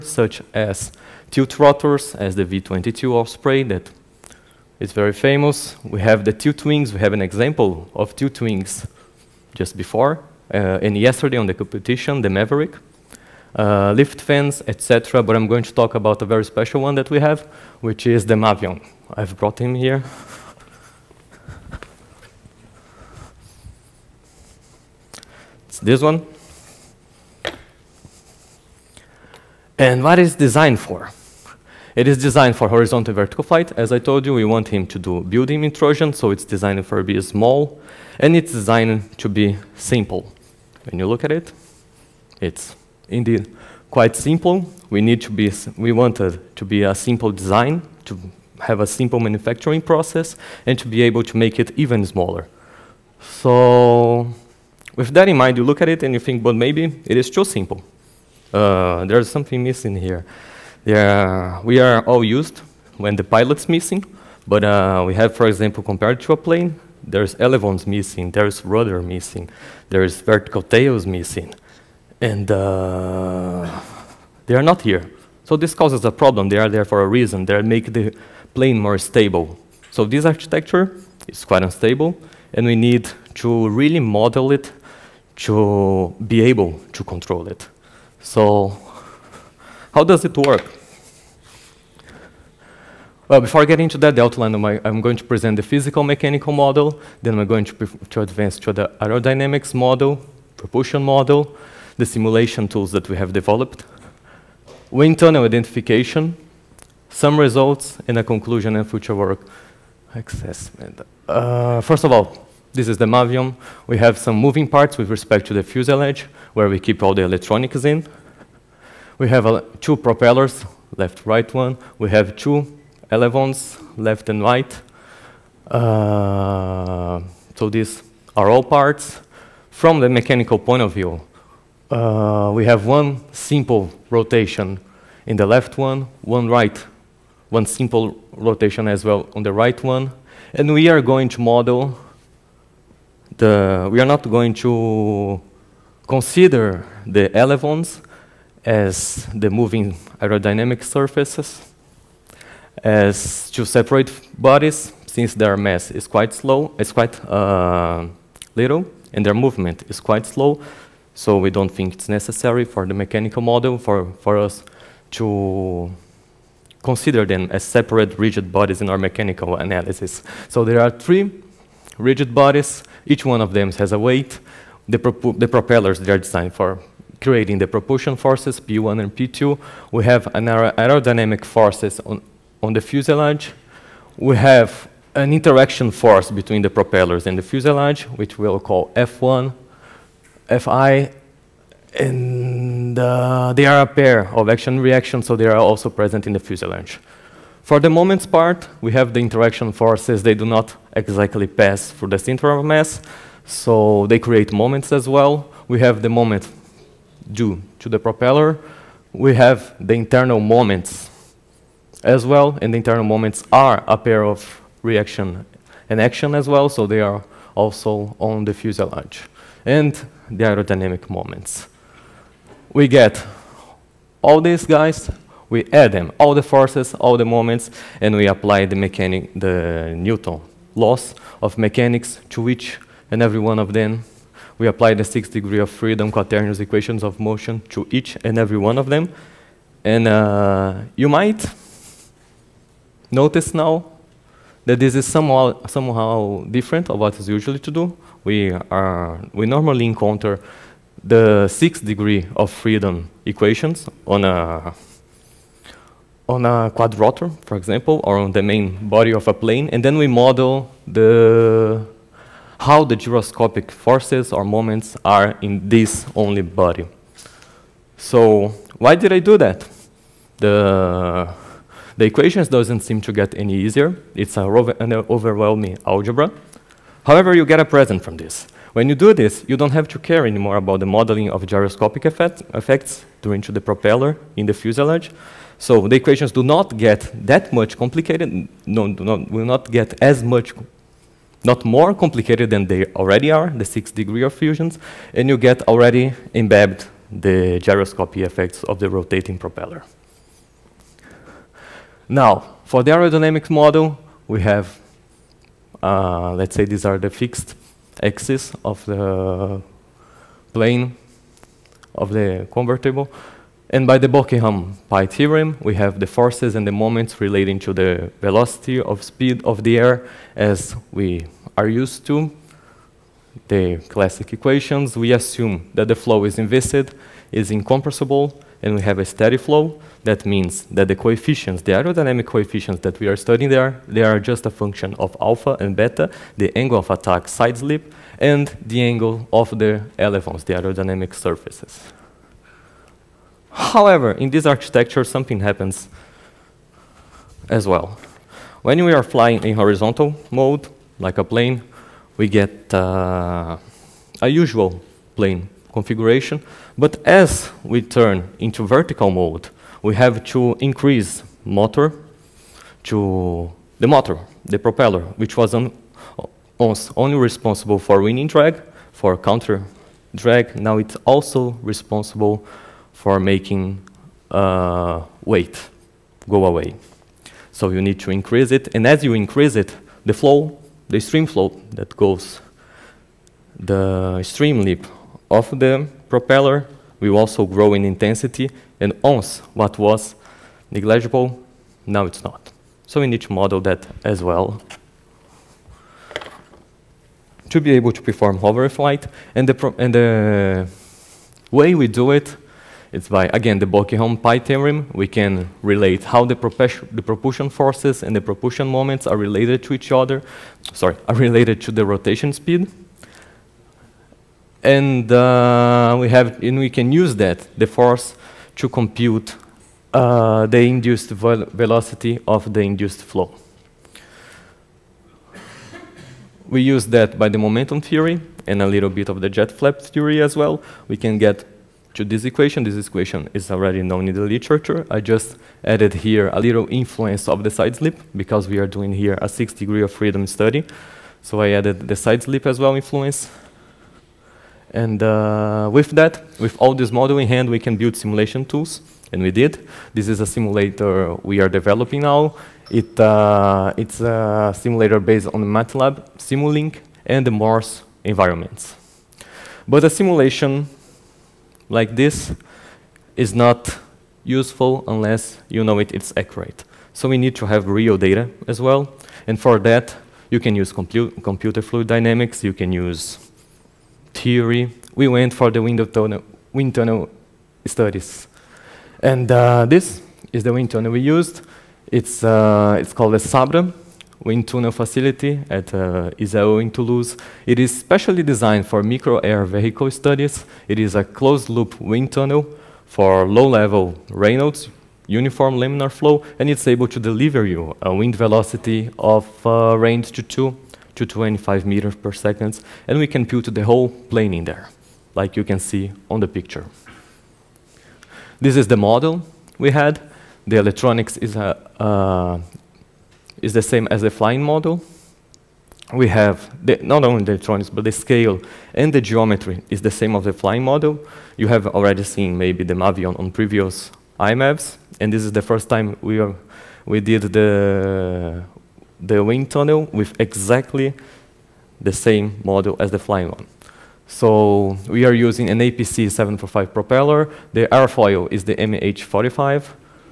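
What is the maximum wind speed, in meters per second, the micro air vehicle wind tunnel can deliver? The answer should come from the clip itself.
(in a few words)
25.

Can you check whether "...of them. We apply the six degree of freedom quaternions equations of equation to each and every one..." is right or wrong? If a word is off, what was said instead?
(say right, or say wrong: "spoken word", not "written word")
wrong: "motion", not "equation".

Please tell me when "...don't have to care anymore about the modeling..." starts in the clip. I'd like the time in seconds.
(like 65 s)
279 s.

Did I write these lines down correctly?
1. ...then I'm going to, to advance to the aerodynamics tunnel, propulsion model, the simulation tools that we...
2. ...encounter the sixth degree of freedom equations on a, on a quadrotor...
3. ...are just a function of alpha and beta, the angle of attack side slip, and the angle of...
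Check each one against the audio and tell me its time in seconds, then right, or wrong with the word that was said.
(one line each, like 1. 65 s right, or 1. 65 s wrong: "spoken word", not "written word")
1. 97 s wrong: "model", not "tunnel"
2. 249 s right
3. 334 s right.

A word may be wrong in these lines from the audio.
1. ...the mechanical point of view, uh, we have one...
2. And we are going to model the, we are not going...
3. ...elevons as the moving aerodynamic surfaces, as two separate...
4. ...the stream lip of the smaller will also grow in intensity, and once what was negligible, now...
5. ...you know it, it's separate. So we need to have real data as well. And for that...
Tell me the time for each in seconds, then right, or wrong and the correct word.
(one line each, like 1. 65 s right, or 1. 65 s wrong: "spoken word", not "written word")
1. 130 s right
2. 140 s right
3. 147 s right
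4. 383 s wrong: "propeller", not "smaller"
5. 465 s wrong: "accurate", not "separate".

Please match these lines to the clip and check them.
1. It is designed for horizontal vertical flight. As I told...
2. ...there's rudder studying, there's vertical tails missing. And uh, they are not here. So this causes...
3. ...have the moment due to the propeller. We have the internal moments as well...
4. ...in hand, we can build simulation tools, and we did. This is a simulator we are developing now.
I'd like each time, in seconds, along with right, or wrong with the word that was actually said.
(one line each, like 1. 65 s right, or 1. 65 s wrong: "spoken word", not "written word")
1. 31 s right
2. 68 s wrong: "missing", not "studying"
3. 205 s right
4. 447 s right.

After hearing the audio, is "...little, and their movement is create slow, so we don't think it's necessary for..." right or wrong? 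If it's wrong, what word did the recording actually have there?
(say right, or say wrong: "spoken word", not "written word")
wrong: "quite", not "create".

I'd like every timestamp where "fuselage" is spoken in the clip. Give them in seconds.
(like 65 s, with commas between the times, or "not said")
115 s, 182 s, 187 s, 196 s, 218 s, 284 s.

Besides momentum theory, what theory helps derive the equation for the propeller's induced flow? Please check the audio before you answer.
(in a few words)
jet flap theory.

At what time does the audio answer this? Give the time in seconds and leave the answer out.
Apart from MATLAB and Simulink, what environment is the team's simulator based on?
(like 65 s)
457 s.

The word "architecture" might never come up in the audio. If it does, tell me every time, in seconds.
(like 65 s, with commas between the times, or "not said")
80 s, 344 s.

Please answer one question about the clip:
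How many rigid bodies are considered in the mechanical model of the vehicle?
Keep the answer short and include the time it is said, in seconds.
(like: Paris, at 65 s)
3, at 170 s.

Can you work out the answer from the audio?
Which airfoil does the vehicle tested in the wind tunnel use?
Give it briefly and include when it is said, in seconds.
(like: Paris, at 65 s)
MH45, at 538 s.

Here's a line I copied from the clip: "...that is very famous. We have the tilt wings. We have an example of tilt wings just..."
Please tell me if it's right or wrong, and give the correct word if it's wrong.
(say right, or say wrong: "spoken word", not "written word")
right.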